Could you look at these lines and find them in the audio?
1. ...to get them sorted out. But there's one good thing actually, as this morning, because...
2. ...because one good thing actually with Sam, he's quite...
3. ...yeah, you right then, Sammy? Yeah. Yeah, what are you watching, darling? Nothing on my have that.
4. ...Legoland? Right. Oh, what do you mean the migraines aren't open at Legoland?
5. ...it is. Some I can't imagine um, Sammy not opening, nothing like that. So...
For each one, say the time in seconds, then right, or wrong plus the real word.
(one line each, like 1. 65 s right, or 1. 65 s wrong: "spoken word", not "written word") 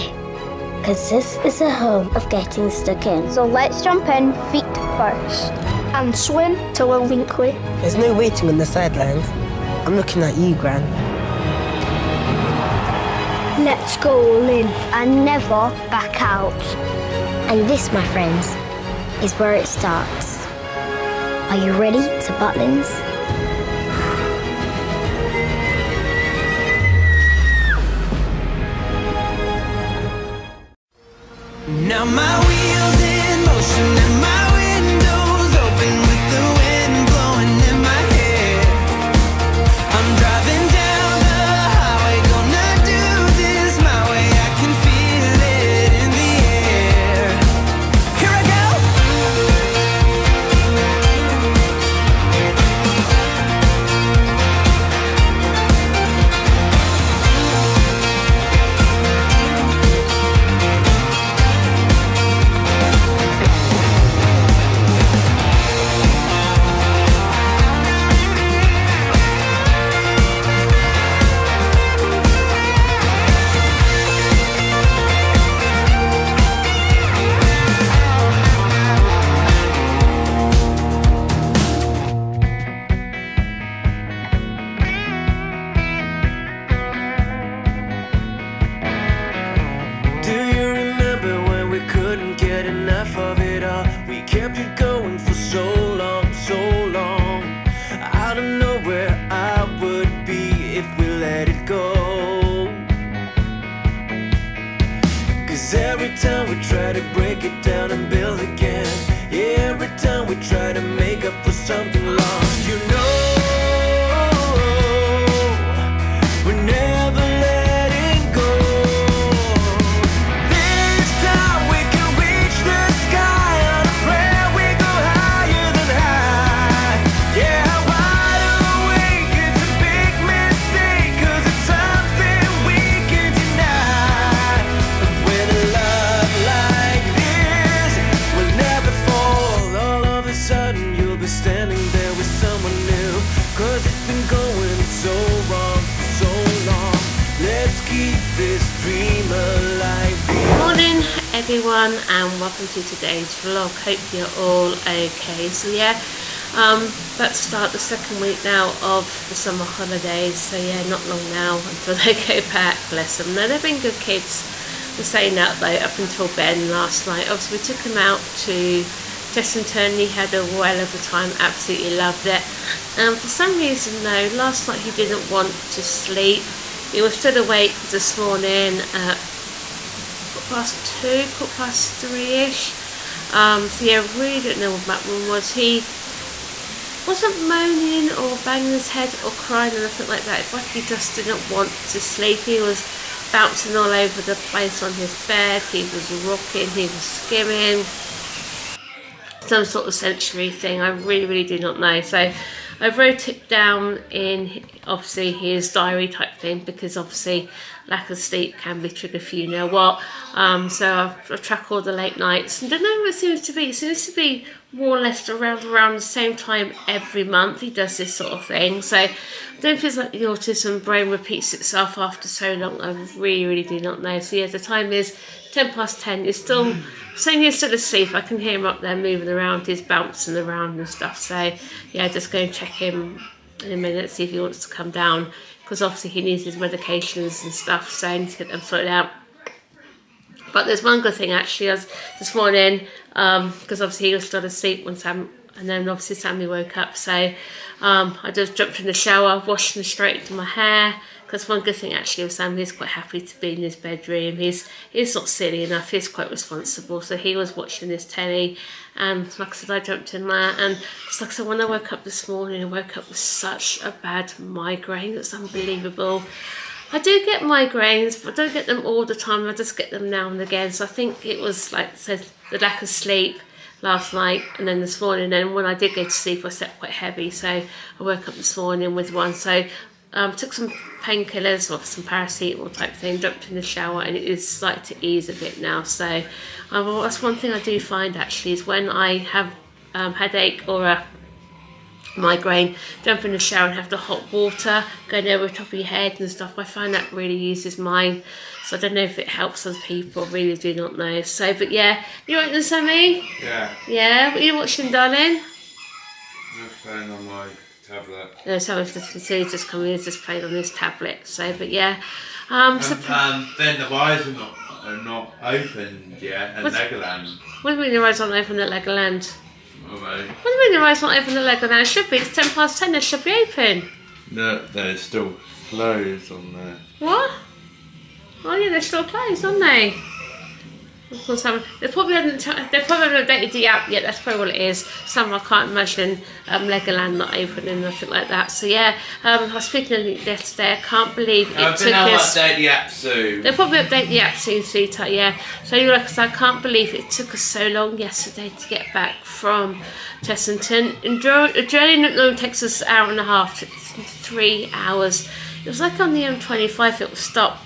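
1. 238 s right
2. 251 s right
3. 301 s right
4. 318 s wrong: "wires", not "migraines"
5. 334 s wrong: "Legoland", not "Sammy".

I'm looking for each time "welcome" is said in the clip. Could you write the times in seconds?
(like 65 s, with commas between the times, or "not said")
152 s.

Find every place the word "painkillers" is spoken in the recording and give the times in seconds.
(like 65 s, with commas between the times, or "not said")
281 s.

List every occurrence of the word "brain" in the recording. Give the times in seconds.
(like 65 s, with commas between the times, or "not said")
220 s.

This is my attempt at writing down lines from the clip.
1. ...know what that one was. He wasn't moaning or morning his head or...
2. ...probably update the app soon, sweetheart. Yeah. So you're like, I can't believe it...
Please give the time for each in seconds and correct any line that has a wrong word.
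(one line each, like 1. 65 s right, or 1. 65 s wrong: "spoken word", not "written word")
1. 184 s wrong: "banging", not "morning"
2. 343 s right.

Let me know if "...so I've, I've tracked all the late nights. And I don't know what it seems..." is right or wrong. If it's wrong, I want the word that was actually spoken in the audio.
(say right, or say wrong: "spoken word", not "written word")
right.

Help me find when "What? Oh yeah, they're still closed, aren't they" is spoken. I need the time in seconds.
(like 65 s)
326 s.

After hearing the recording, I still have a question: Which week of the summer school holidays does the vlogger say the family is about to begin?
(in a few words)
second.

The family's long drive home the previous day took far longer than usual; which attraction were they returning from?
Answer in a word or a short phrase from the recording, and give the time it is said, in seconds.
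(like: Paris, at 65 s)
Chessington, at 350 s.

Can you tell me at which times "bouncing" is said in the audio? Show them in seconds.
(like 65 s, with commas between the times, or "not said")
193 s, 229 s.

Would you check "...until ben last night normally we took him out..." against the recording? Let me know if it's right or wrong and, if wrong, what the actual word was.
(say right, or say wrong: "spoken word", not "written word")
wrong: "obviously", not "normally".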